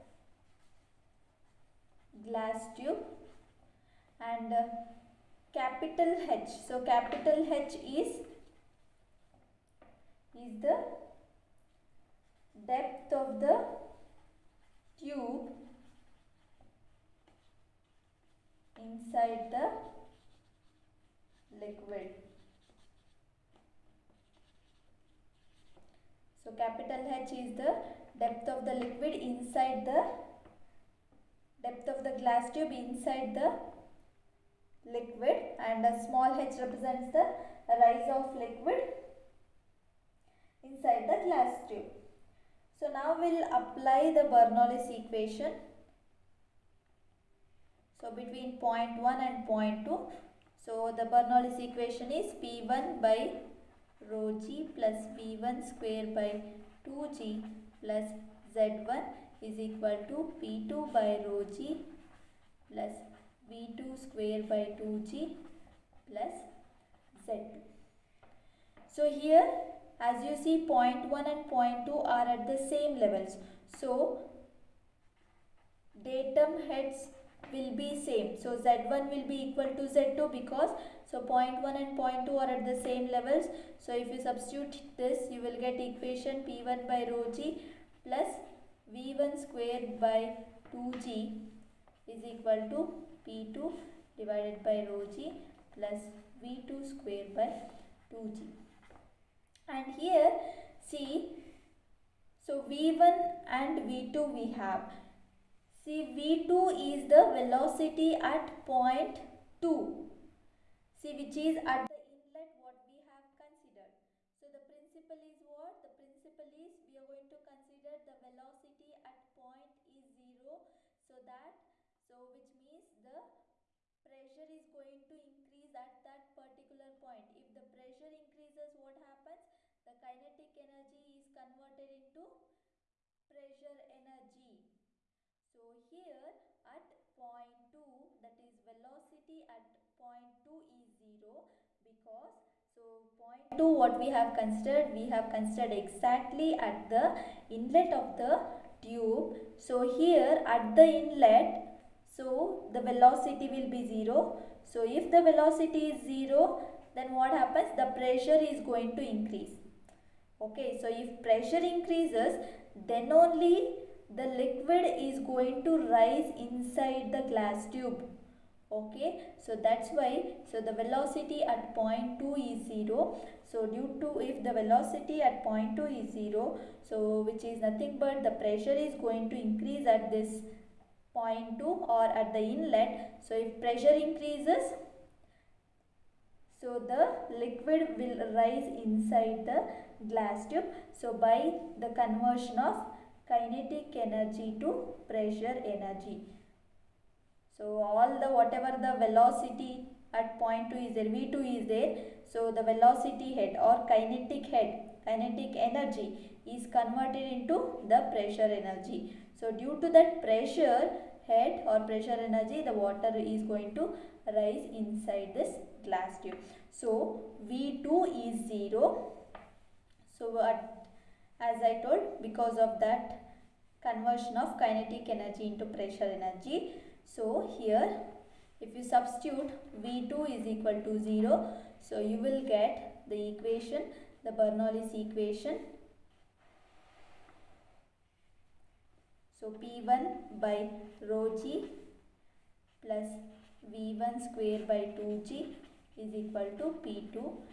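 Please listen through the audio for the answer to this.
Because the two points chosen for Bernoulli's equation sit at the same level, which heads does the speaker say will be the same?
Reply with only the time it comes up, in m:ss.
1:16.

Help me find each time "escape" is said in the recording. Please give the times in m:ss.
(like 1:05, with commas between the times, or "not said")
not said.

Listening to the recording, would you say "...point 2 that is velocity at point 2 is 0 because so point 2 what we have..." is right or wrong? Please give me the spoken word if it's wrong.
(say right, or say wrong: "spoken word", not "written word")
right.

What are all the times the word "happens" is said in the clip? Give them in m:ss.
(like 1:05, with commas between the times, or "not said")
2:08, 2:37.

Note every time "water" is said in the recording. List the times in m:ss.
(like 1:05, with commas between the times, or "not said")
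3:32.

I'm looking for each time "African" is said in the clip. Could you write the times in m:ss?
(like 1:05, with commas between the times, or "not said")
not said.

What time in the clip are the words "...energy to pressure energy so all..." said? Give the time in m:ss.
3:14.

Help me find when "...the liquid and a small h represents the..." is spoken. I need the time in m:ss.
0:33.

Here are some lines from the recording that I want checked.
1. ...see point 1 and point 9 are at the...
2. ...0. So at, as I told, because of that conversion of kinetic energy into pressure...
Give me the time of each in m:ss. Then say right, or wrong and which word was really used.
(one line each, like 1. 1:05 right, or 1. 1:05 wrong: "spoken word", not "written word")
1. 1:10 wrong: "2", not "9"
2. 3:38 right.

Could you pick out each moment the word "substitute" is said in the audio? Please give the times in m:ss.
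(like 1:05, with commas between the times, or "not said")
1:24, 3:48.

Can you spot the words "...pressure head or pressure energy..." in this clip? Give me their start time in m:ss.
3:30.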